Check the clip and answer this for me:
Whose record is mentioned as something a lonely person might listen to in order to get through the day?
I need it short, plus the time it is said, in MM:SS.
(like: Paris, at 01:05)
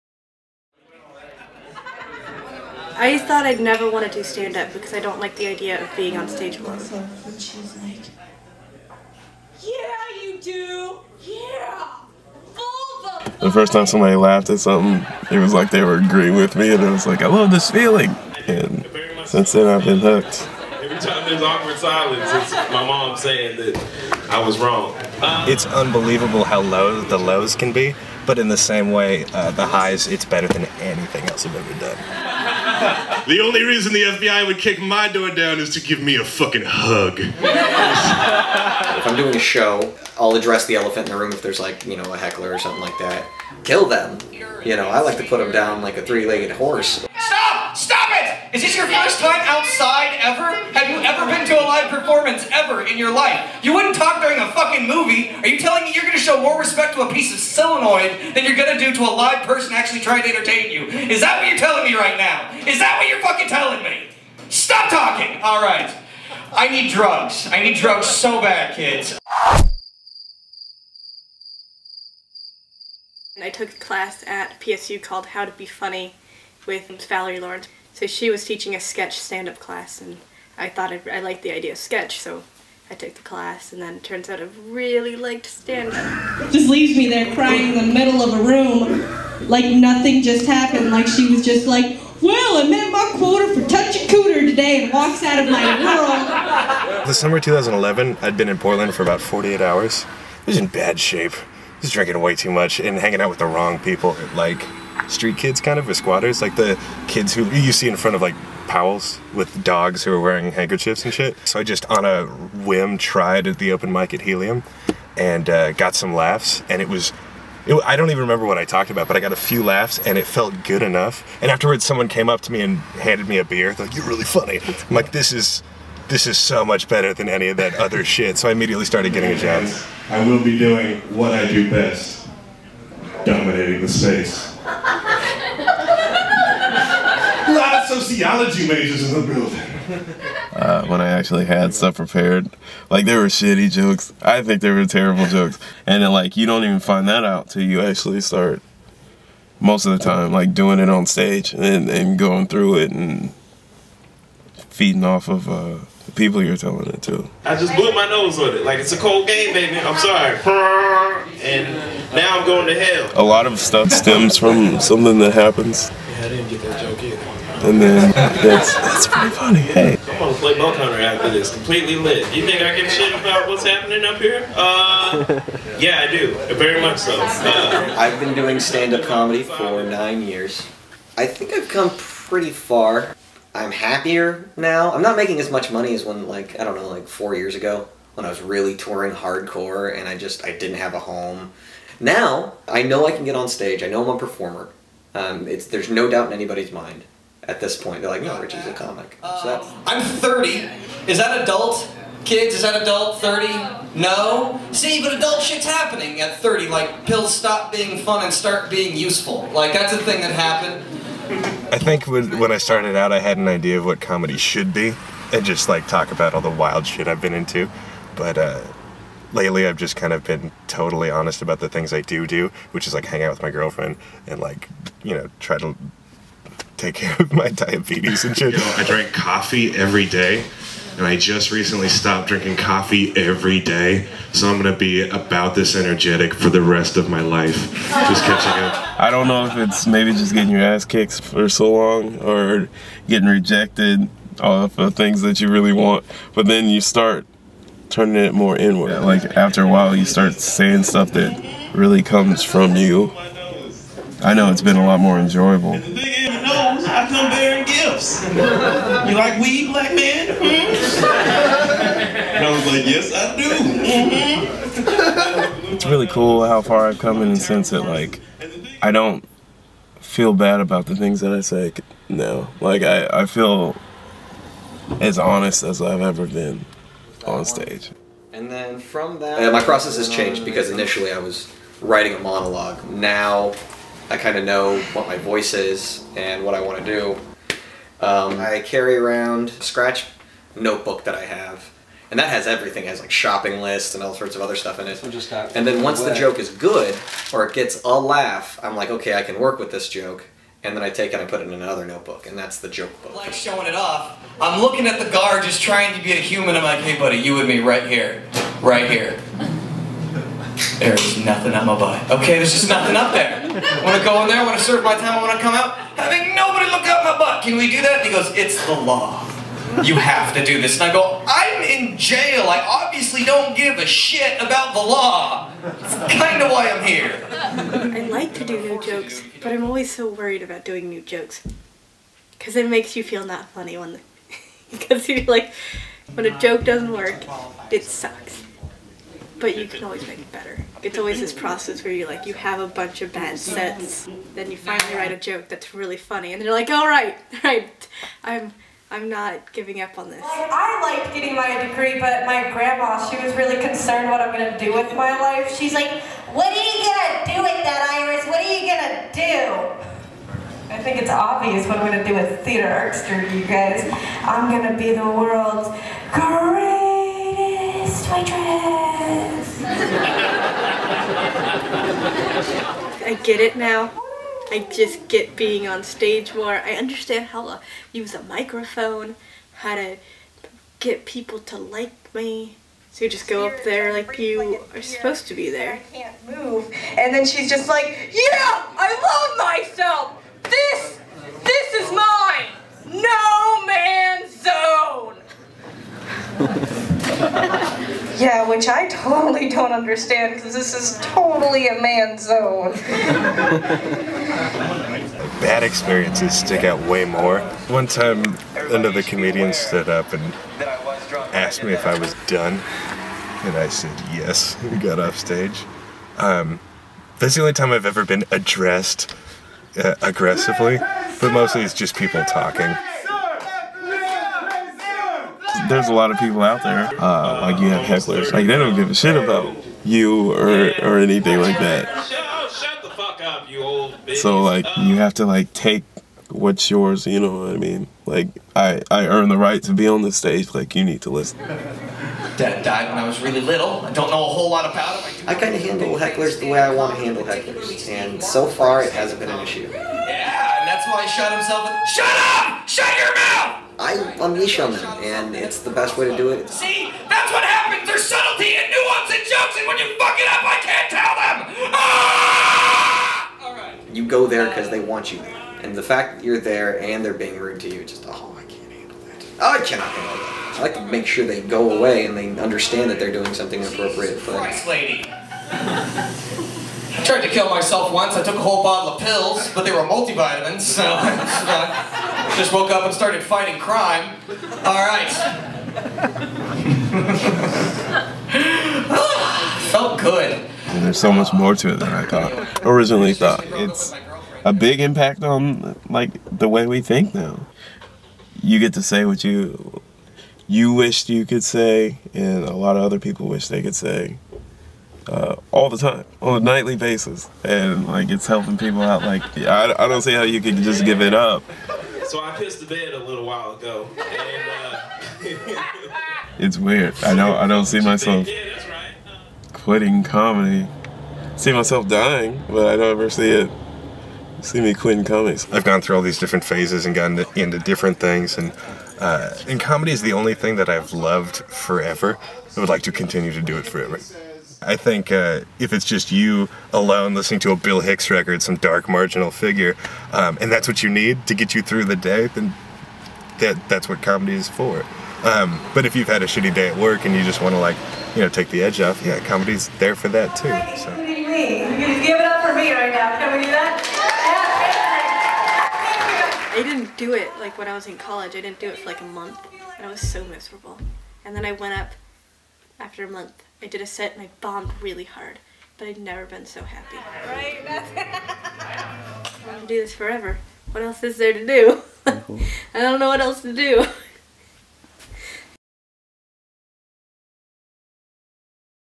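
Bill Hicks, at 08:57.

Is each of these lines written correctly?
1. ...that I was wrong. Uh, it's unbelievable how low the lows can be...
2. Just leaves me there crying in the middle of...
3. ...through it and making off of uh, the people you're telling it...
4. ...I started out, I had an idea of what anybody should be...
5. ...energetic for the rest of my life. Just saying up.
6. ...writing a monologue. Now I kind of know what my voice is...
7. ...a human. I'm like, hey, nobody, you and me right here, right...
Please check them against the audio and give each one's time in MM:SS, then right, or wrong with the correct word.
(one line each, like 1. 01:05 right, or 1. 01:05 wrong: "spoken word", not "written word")
1. 00:23 right
2. 01:26 right
3. 02:32 wrong: "feeding", not "making"
4. 03:32 wrong: "comedy", not "anybody"
5. 03:55 wrong: "catching", not "saying"
6. 04:41 right
7. 05:06 wrong: "buddy", not "nobody".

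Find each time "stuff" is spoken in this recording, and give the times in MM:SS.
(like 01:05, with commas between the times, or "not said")
02:21, 02:43, 04:10, 04:54.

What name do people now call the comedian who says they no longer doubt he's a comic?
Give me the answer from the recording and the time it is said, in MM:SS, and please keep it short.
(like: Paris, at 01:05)
Richie, at 03:18.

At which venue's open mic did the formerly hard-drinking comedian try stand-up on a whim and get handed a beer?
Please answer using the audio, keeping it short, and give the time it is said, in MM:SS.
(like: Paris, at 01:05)
Helium, at 01:54.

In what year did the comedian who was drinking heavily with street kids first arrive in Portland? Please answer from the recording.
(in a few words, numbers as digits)
2011.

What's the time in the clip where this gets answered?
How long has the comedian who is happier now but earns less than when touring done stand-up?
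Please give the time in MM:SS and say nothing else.
02:59.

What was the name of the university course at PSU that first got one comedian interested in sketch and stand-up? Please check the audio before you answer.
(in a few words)
How to Be Funny.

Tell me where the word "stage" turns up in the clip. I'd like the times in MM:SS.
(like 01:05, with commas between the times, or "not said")
00:06, 02:31, 03:13, 04:37, 06:15, 06:55, 07:20.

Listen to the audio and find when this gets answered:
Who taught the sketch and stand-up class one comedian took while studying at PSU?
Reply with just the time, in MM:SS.
01:17.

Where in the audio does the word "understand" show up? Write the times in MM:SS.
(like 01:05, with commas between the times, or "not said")
06:16, 06:39, 07:52.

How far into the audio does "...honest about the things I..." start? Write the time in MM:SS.
03:41.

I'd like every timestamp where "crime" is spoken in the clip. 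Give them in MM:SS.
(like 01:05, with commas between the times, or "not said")
08:03.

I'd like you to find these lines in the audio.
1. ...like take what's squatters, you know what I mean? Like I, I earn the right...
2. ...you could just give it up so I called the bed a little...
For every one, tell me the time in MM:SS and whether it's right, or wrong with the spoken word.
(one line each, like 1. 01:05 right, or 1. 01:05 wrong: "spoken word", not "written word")
1. 07:15 wrong: "yours", not "squatters"
2. 08:30 wrong: "pissed", not "called".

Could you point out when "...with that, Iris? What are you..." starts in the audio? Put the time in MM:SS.
05:57.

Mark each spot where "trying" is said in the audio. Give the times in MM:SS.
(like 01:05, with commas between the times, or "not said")
01:00, 05:05.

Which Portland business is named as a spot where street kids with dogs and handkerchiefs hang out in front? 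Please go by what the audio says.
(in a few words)
Powell's.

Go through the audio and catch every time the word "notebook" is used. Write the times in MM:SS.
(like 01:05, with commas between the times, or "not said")
04:50, 05:01.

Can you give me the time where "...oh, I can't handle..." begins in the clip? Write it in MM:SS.
07:48.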